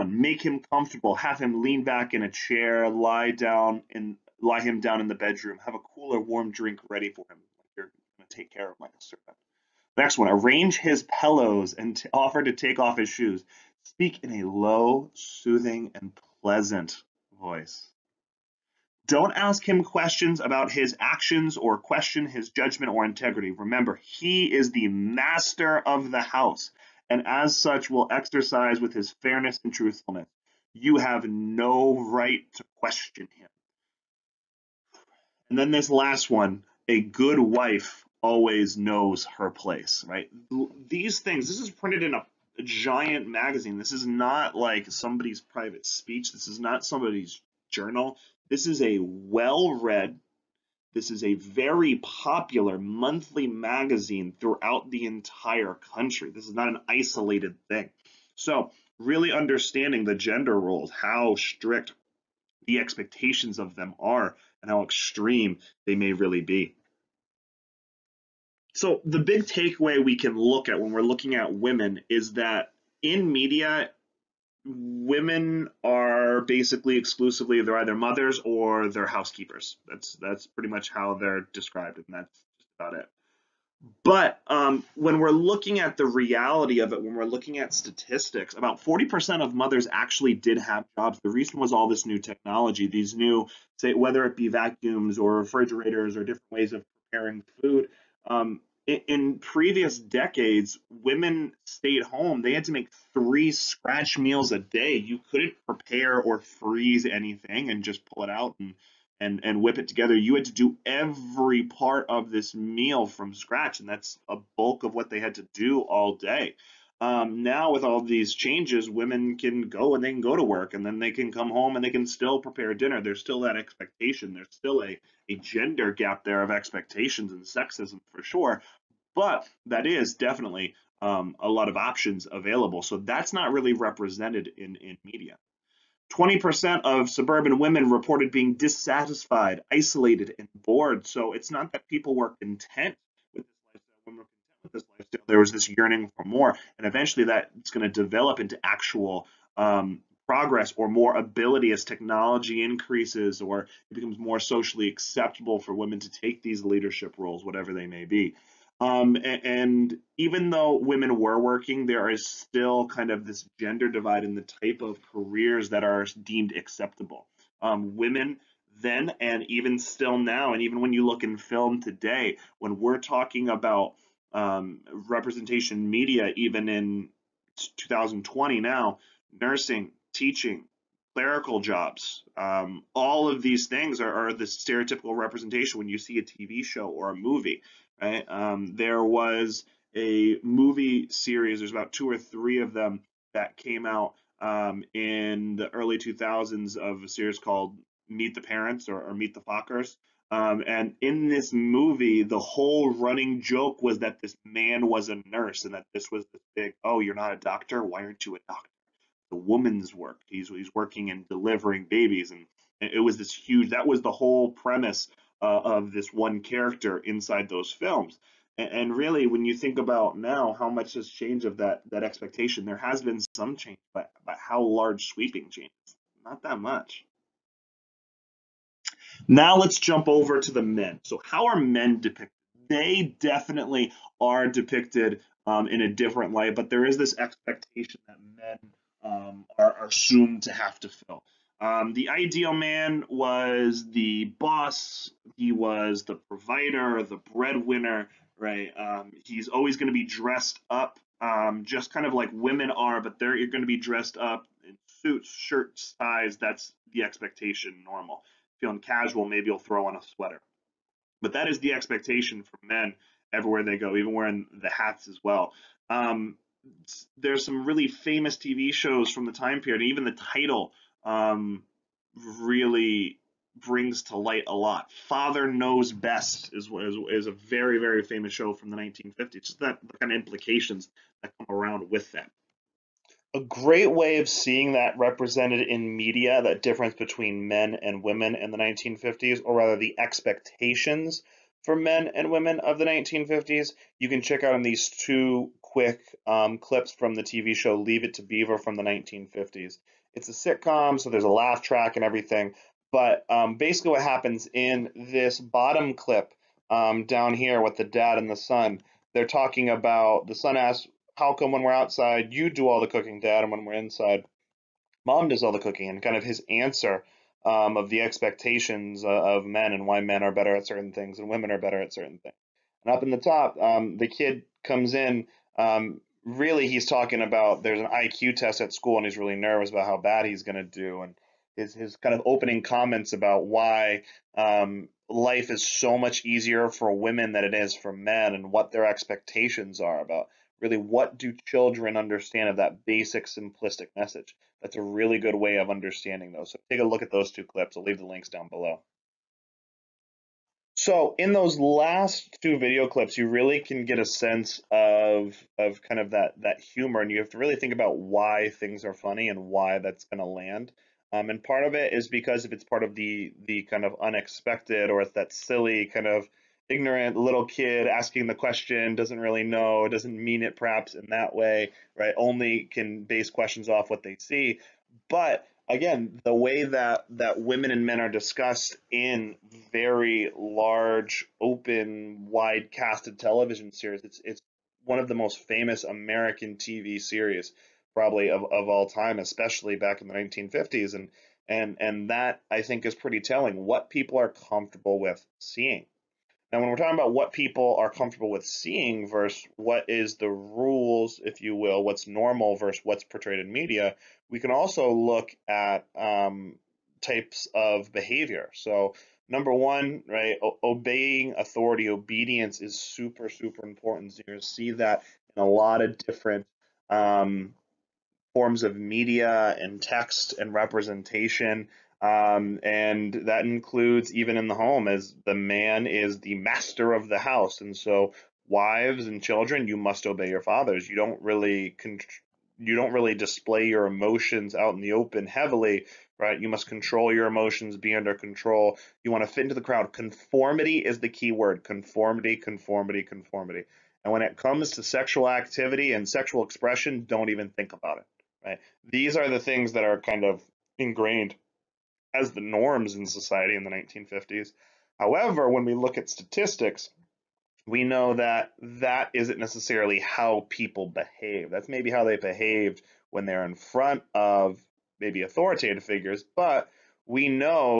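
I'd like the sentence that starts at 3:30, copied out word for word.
He's, he's working and delivering babies.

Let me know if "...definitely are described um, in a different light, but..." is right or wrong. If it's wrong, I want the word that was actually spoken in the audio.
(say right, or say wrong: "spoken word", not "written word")
wrong: "depicted", not "described".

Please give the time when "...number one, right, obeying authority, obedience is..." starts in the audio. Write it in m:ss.
6:49.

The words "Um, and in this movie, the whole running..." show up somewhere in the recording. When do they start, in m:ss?
3:20.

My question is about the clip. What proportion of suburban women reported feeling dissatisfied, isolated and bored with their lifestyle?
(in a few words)
20%.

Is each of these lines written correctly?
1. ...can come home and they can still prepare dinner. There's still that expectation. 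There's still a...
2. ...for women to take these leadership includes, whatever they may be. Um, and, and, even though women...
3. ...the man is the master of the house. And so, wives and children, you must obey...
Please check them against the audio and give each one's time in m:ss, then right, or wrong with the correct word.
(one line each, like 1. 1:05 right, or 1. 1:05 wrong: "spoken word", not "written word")
1. 2:01 right
2. 2:35 wrong: "roles", not "includes"
3. 7:05 right.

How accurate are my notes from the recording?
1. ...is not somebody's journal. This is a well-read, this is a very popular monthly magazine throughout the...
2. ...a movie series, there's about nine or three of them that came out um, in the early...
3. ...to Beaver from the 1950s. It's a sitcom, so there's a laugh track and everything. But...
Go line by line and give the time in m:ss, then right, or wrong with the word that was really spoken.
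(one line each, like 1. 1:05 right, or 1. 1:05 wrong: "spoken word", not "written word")
1. 0:46 right
2. 3:09 wrong: "two", not "nine"
3. 4:58 right.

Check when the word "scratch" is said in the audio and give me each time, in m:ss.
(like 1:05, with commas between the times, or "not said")
1:43, 1:53.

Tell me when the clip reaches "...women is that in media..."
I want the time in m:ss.
1:11.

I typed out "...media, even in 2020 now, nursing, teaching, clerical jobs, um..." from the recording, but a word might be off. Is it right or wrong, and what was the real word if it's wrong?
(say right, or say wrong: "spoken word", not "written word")
right.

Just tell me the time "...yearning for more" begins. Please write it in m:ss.
2:25.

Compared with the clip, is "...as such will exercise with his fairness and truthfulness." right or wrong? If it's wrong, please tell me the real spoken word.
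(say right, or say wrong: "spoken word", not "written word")
right.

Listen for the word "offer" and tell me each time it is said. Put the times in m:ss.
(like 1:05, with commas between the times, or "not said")
0:12.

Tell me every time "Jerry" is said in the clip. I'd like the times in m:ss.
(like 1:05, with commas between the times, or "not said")
not said.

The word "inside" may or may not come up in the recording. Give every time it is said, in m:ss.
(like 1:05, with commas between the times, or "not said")
3:36, 5:13.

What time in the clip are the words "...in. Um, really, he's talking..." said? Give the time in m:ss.
5:24.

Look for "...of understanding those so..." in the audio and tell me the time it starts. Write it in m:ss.
5:45.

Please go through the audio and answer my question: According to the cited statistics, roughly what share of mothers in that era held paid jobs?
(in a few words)
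40%.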